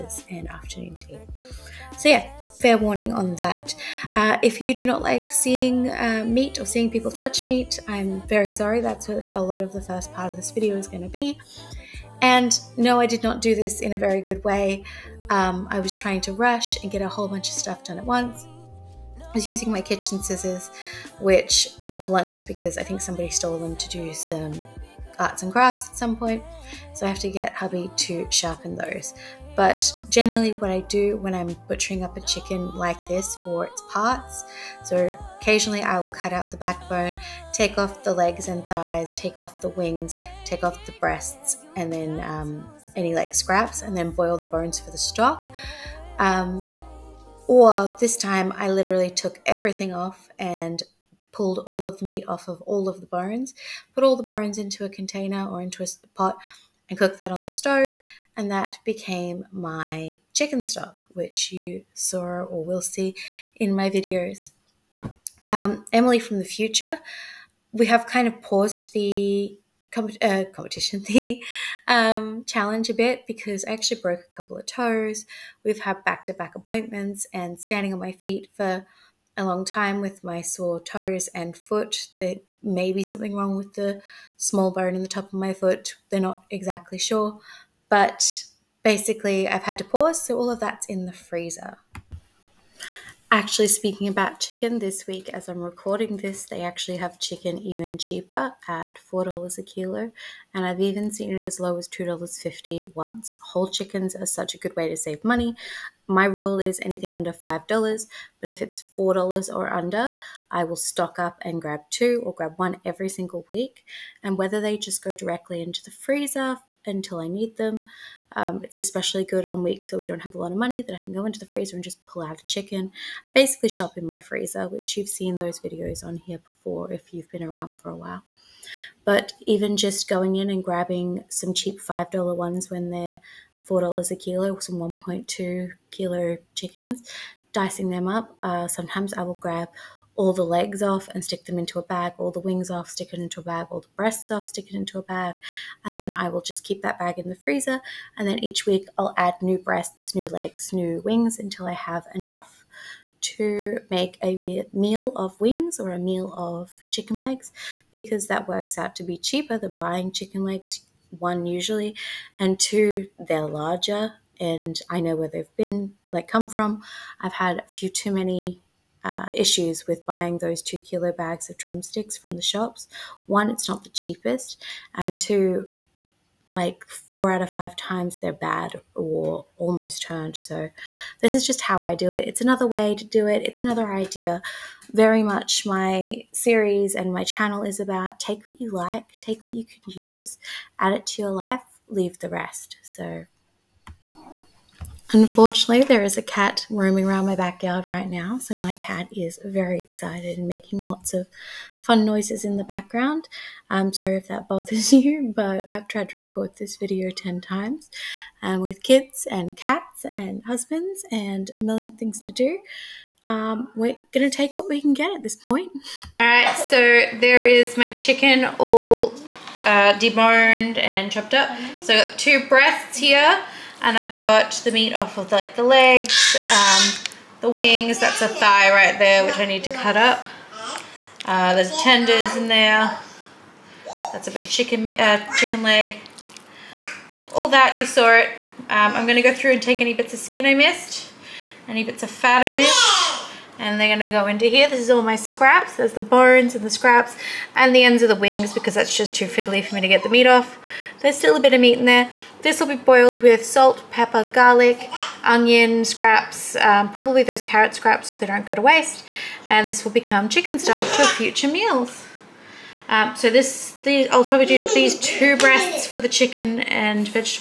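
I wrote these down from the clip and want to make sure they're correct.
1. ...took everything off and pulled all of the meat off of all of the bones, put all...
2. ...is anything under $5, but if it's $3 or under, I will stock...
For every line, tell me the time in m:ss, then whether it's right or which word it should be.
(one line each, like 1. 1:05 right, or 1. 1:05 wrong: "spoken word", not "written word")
1. 0:49 right
2. 1:46 wrong: "4", not "3".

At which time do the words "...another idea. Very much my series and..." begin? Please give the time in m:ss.
3:03.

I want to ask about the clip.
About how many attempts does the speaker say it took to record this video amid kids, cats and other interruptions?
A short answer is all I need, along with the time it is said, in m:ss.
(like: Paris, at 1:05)
10, at 3:27.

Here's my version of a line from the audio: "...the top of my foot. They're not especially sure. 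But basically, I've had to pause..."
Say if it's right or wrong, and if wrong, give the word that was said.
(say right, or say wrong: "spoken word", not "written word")
wrong: "exactly", not "especially".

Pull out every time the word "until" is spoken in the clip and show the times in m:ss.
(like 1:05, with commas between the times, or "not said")
1:56, 2:31.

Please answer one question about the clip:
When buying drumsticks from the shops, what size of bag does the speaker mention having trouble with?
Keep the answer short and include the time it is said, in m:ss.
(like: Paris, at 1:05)
two kilo, at 2:50.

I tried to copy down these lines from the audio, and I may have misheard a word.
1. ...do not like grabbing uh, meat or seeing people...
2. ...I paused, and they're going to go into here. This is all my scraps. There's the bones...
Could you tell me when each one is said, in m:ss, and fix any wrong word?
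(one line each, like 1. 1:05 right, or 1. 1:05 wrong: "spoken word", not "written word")
1. 0:04 wrong: "seeing", not "grabbing"
2. 4:02 wrong: "missed", not "paused".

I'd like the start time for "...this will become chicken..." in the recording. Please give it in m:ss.
4:19.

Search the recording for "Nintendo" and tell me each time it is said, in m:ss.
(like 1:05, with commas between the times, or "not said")
not said.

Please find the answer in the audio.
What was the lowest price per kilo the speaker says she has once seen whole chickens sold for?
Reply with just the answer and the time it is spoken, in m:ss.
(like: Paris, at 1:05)
$2.50, at 1:41.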